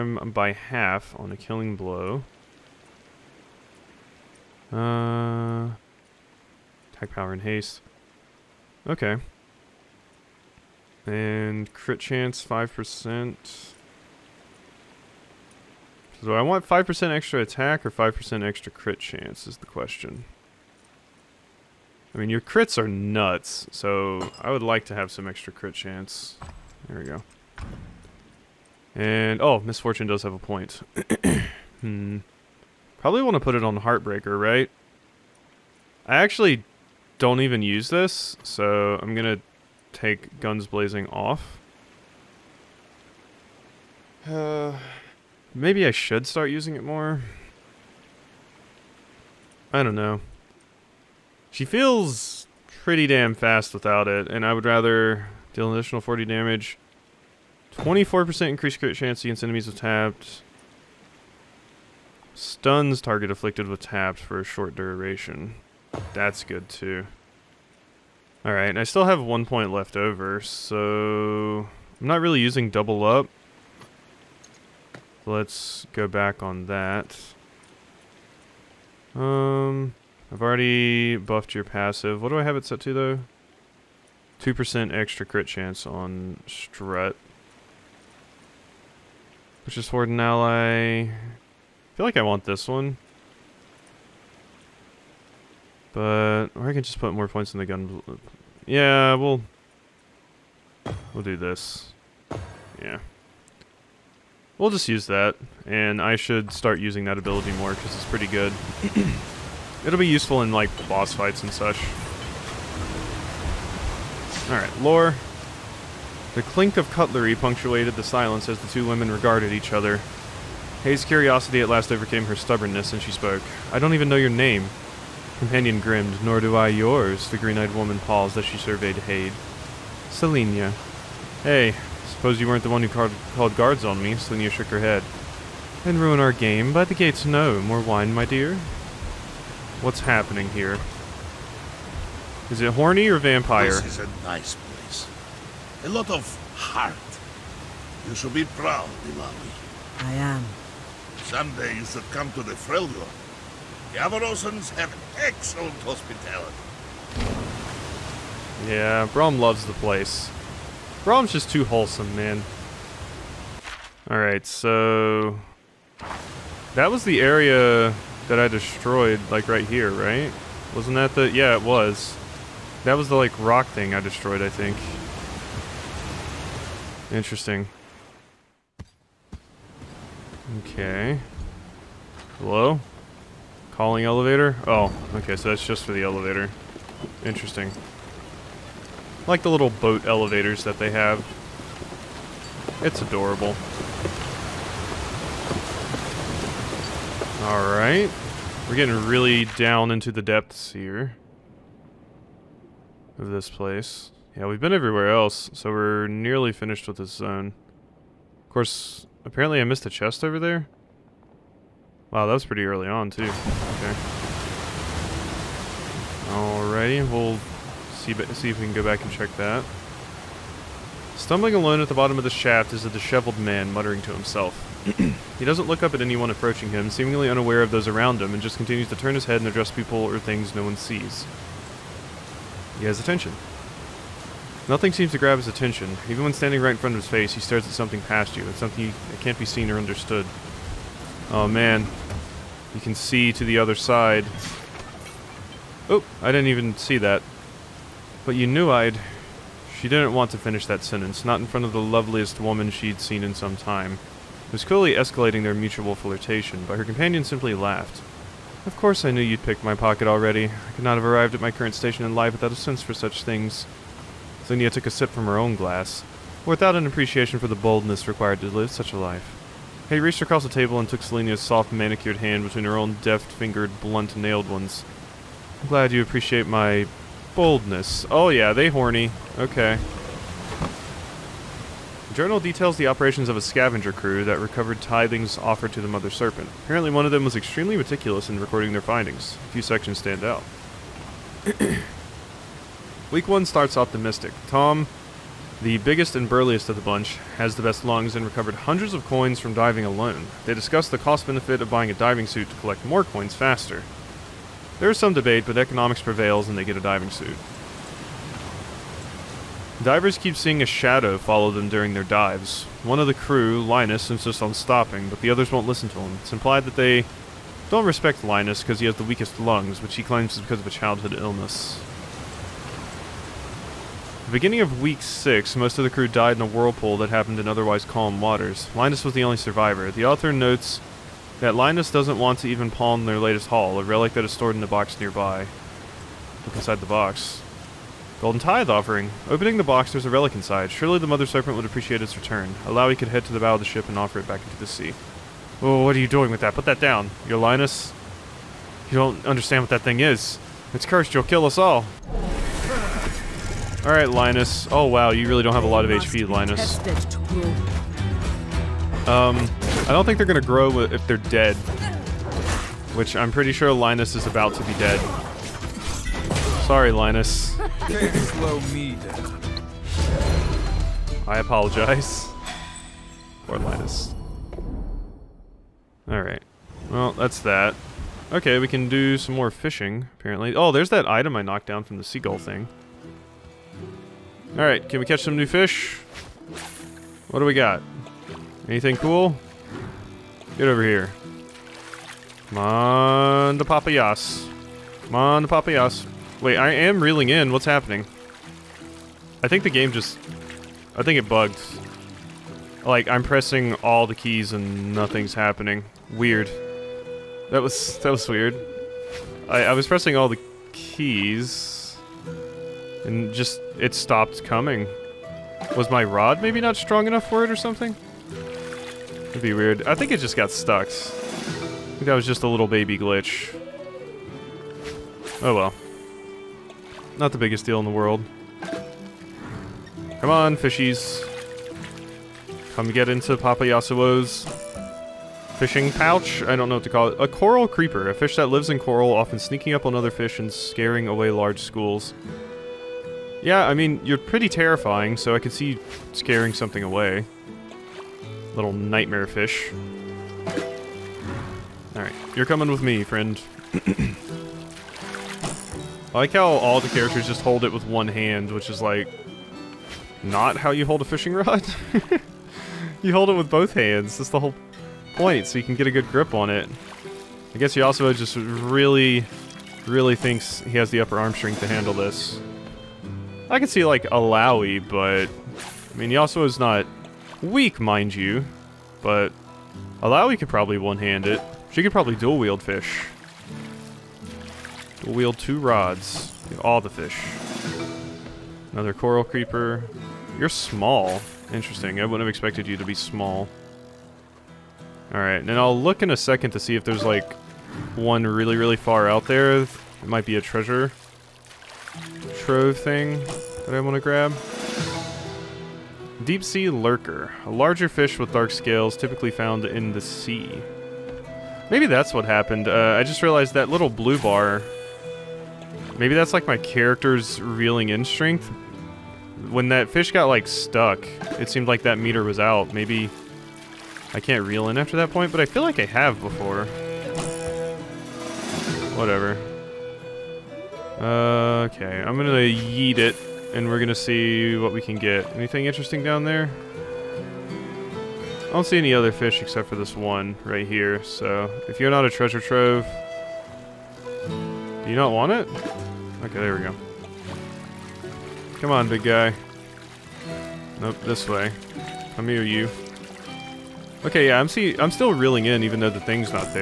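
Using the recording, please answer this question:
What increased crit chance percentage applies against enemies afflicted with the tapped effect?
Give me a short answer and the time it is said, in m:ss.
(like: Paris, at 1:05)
24%, at 0:57.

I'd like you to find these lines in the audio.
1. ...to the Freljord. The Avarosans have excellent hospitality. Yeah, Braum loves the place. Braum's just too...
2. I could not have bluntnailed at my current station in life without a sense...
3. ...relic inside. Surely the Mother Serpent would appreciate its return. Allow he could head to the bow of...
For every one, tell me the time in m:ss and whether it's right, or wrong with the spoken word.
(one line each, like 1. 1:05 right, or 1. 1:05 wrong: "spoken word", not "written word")
1. 2:32 right
2. 4:20 wrong: "arrived", not "bluntnailed"
3. 5:40 right.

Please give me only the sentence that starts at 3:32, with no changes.
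Wow, that was pretty early on, too.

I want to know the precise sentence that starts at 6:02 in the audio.
Which I'm pretty sure Linus is about to be dead.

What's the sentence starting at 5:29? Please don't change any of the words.
The author notes that Linus doesn't want to even pawn their latest haul, a relic that is stored in a box nearby.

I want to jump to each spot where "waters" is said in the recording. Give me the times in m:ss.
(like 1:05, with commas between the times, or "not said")
5:28.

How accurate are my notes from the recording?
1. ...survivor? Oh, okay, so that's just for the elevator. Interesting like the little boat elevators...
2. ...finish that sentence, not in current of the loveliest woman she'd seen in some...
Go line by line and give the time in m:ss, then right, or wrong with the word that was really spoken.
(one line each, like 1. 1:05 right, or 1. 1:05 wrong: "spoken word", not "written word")
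1. 3:04 wrong: "elevator", not "survivor"
2. 4:10 wrong: "front", not "current".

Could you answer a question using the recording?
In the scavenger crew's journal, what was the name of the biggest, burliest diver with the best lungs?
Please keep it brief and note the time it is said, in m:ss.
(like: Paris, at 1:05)
Tom, at 4:54.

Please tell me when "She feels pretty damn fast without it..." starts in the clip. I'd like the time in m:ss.
0:51.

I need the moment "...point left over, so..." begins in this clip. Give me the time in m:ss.
1:09.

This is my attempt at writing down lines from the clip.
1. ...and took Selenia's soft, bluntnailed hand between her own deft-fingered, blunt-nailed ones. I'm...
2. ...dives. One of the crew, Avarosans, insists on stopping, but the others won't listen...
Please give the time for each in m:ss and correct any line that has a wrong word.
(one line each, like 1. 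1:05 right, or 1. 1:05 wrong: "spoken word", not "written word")
1. 4:30 wrong: "manicured", not "bluntnailed"
2. 5:12 wrong: "Linus", not "Avarosans".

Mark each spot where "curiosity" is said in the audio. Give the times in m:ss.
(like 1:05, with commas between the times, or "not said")
2:01.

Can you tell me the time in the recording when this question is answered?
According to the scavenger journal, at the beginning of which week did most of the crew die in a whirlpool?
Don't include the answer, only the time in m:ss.
5:24.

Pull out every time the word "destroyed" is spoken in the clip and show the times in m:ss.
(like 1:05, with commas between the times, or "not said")
2:48, 2:54.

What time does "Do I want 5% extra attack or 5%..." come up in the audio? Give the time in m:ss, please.
0:16.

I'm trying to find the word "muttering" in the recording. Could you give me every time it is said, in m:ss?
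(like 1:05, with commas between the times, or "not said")
3:43.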